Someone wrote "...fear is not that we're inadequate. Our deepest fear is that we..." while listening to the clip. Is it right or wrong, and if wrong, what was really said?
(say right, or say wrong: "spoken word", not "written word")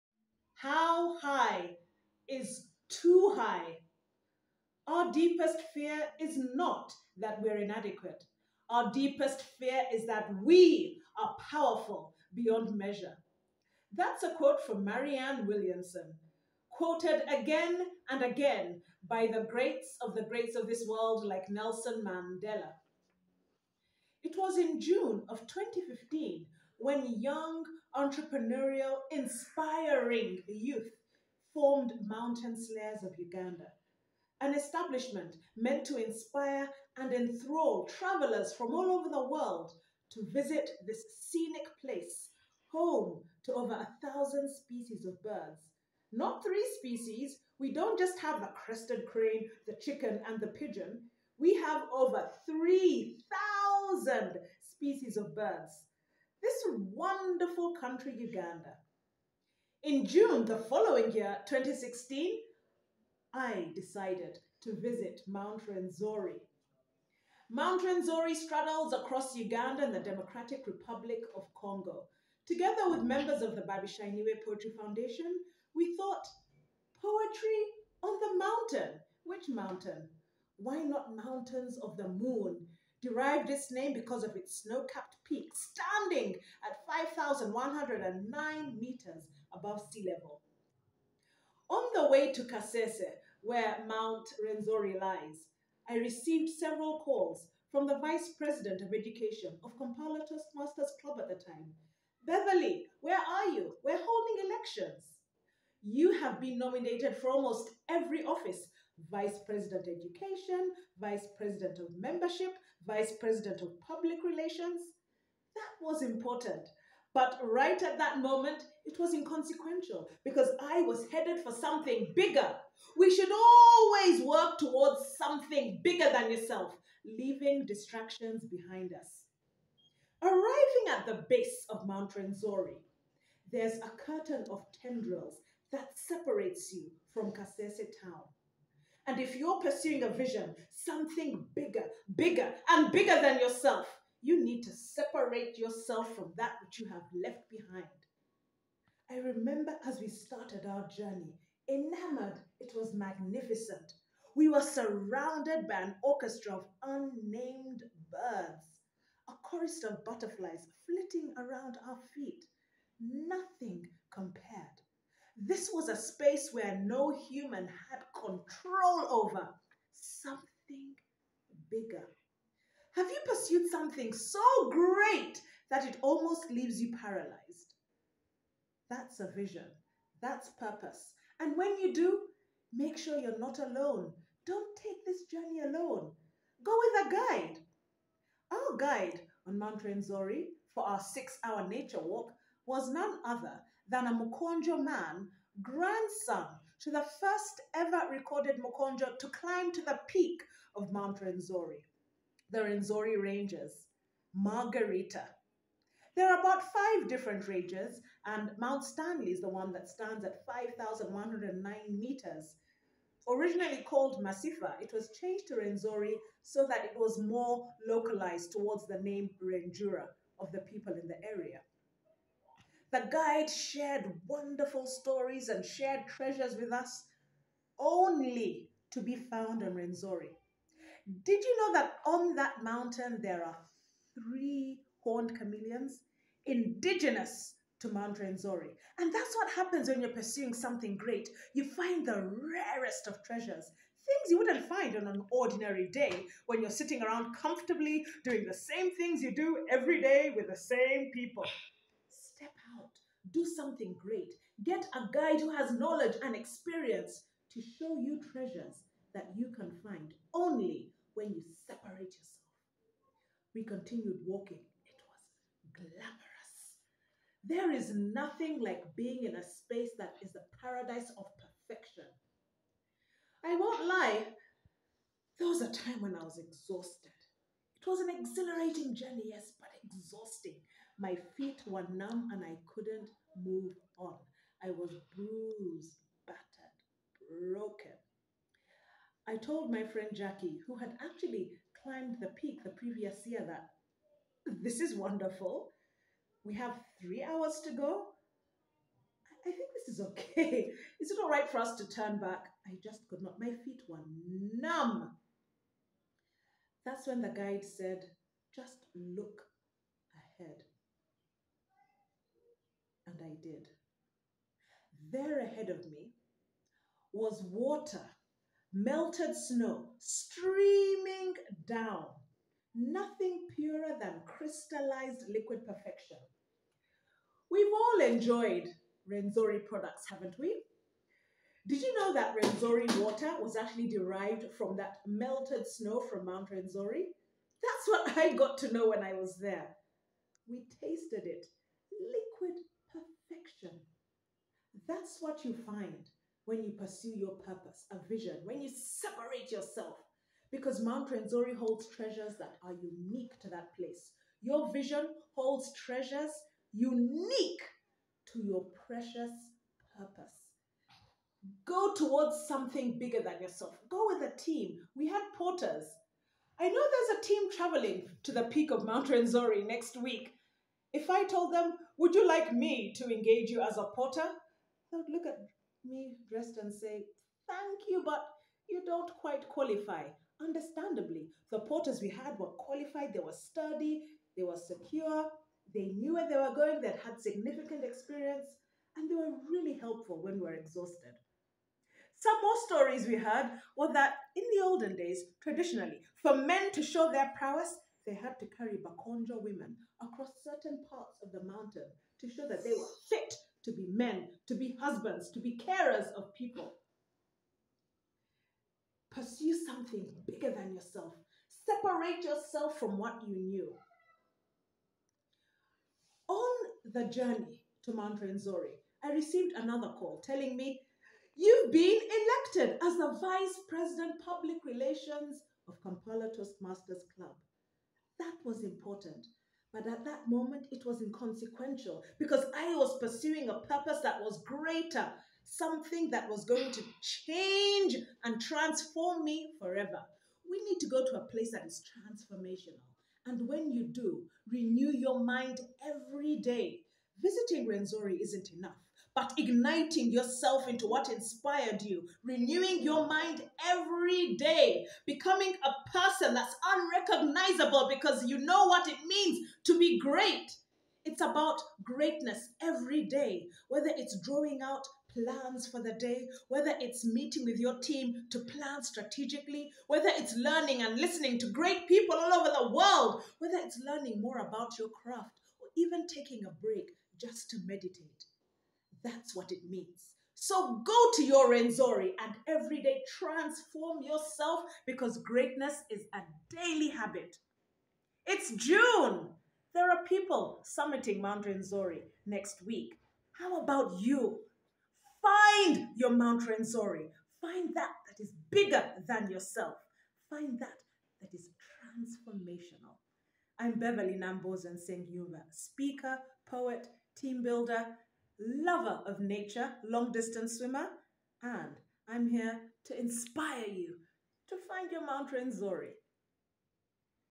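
right.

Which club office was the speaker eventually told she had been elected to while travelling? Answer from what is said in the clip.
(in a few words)
Vice President Public Relations.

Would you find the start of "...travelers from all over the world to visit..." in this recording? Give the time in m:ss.
0:37.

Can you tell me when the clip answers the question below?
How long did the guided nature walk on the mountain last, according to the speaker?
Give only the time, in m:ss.
3:10.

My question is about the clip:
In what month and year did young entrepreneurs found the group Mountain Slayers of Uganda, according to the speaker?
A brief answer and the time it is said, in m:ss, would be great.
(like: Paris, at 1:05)
June 2015, at 0:24.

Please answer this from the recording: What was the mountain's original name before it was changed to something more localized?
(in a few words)
Masifa.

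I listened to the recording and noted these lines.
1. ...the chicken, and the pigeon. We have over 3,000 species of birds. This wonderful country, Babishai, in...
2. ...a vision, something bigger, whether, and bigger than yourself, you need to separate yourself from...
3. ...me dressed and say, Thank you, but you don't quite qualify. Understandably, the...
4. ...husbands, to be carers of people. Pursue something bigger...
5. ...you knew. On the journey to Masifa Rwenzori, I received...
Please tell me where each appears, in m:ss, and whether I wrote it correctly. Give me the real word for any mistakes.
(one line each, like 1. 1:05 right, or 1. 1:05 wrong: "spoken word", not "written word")
1. 0:49 wrong: "Uganda", not "Babishai"
2. 2:20 wrong: "bigger", not "whether"
3. 6:15 right
4. 6:44 right
5. 6:53 wrong: "Mount", not "Masifa".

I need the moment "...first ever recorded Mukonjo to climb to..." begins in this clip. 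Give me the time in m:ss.
3:17.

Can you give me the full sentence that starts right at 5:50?
Because Mount Rwenzori holds treasures that are unique to that place.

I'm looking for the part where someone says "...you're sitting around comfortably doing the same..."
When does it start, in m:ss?
4:06.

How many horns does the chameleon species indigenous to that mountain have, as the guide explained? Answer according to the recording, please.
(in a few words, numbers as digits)
3.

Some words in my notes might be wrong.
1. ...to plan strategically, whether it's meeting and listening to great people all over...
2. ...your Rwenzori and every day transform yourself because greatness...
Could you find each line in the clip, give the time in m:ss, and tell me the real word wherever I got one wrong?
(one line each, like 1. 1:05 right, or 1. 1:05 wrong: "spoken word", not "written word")
1. 7:48 wrong: "learning", not "meeting"
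2. 8:01 right.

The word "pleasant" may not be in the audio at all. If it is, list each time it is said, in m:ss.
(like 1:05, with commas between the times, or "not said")
not said.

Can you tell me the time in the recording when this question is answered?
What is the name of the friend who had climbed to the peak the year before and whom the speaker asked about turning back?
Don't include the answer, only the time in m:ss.
4:50.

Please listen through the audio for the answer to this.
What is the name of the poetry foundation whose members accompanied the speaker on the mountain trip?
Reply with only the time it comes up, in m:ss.
1:13.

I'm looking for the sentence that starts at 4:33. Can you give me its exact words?
I won't lie, there was a time when I was exhausted.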